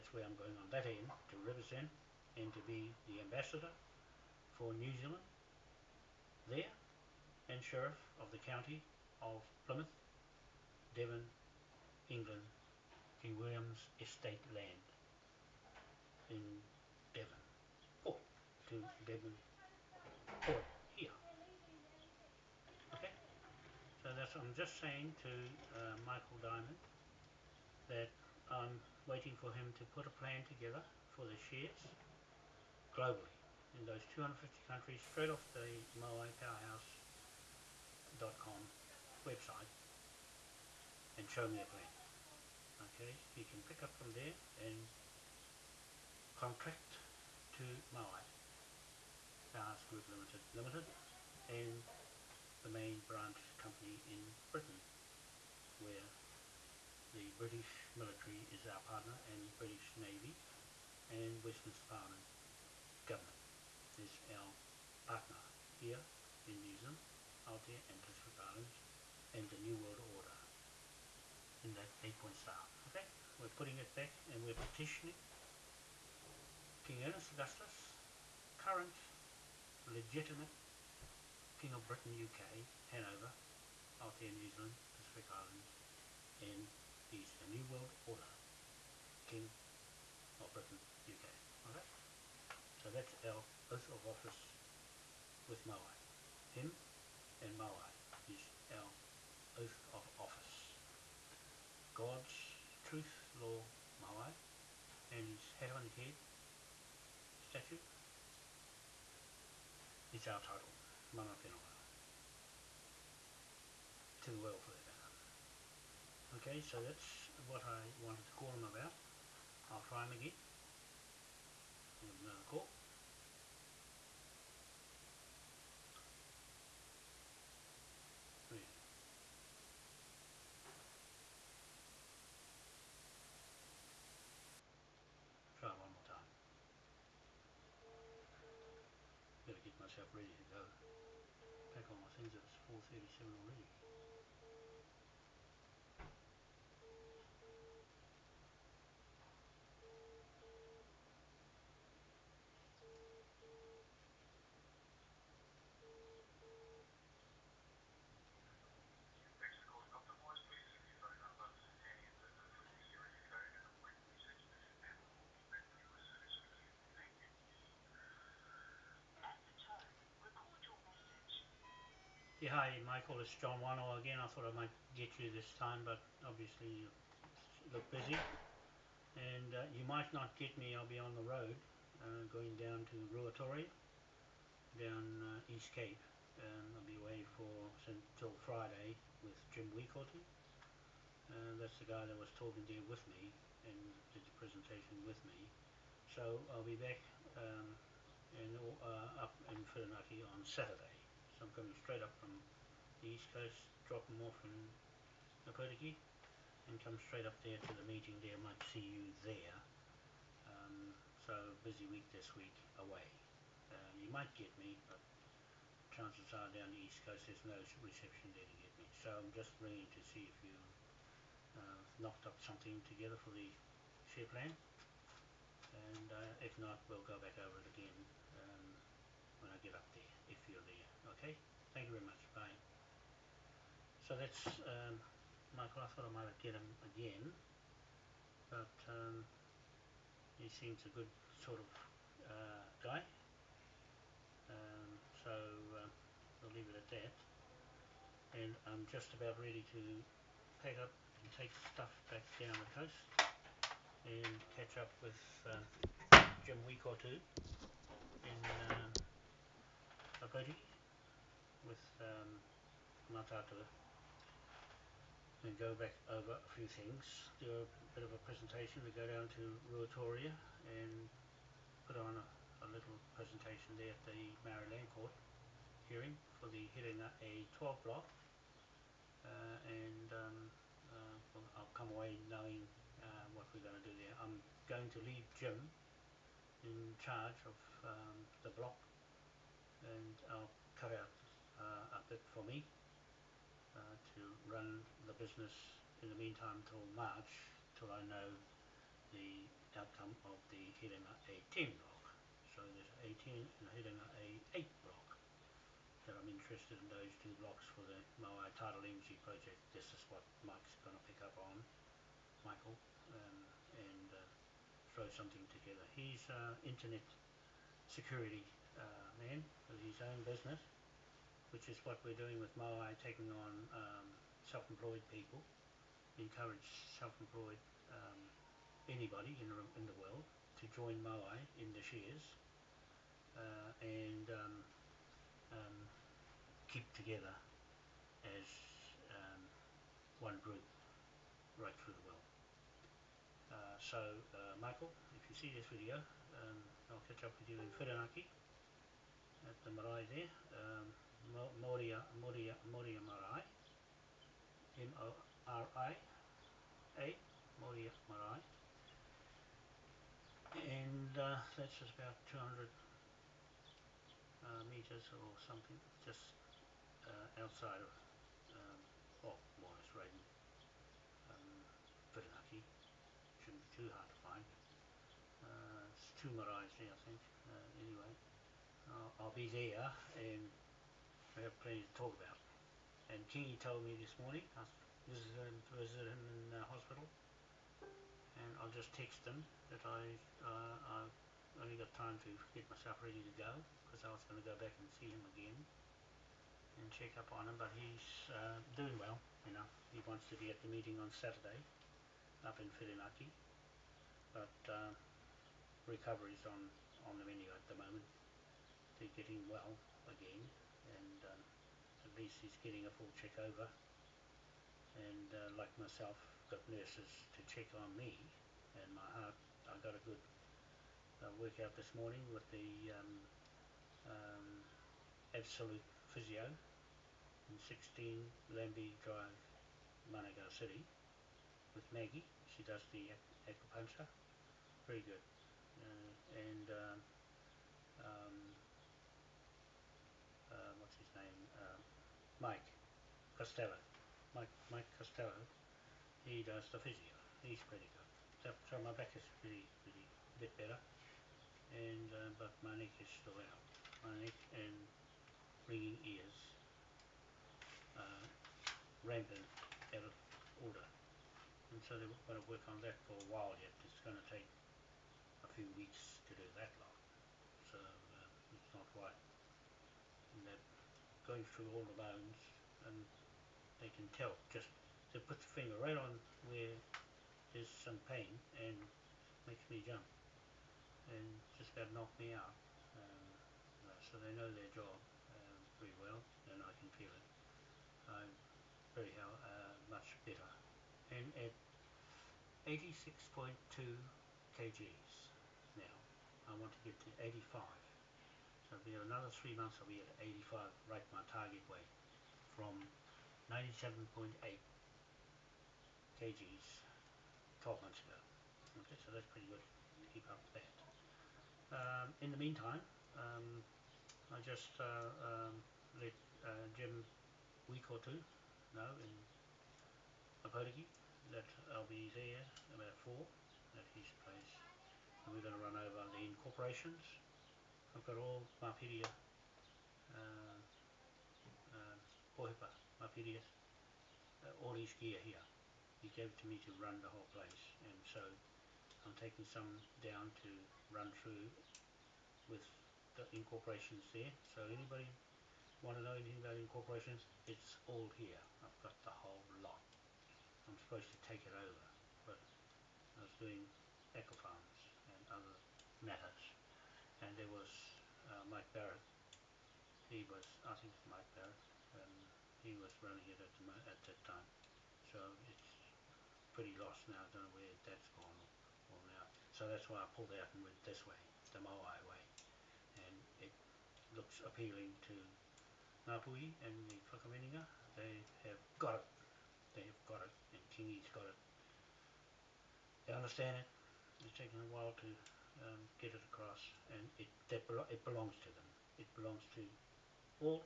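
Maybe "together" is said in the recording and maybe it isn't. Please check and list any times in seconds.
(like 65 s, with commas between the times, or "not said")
30 s, 222 s, 315 s, 336 s.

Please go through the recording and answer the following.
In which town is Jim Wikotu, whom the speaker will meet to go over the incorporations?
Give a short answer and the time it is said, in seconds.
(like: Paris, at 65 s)
Opotiki, at 520 s.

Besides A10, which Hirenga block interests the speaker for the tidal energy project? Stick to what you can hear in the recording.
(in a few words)
A8.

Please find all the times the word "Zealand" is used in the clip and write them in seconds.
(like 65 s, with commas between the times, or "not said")
5 s, 66 s, 84 s.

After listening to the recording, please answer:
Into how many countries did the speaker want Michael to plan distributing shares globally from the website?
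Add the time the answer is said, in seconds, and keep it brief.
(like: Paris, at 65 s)
250, at 34 s.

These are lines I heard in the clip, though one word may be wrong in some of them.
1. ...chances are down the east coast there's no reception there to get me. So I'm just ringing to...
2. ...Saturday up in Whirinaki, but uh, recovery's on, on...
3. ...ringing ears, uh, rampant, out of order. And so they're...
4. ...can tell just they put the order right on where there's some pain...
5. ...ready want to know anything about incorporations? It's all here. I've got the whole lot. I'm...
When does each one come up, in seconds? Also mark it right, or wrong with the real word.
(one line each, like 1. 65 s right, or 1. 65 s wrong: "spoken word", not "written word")
1. 215 s right
2. 401 s right
3. 455 s right
4. 473 s wrong: "finger", not "order"
5. 544 s wrong: "anybody", not "ready".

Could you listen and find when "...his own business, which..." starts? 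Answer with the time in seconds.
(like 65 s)
319 s.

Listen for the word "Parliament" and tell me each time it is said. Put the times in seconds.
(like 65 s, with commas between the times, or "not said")
61 s.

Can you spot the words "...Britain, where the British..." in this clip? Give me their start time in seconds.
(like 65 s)
54 s.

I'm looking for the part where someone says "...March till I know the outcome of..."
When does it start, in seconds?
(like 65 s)
296 s.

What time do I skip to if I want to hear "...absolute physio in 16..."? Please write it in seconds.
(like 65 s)
425 s.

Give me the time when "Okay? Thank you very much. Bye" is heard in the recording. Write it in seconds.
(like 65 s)
231 s.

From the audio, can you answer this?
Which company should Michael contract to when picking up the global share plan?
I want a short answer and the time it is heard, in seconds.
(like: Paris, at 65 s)
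Moai Powerhouse Group Limited, at 47 s.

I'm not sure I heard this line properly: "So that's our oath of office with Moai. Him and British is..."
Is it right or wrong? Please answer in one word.
wrong.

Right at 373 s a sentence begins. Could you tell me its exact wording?
Shouldn't be too hard to find.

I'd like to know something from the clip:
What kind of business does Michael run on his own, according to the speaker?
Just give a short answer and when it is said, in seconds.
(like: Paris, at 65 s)
Internet security, at 316 s.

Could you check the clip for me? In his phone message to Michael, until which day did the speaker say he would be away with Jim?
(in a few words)
Friday.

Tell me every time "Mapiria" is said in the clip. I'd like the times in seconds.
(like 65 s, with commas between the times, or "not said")
528 s, 532 s.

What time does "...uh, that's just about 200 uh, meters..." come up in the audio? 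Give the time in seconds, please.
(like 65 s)
361 s.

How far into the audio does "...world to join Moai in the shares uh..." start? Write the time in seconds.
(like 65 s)
330 s.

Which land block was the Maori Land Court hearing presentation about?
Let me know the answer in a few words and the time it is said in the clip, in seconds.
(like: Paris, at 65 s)
Hirena A12, at 276 s.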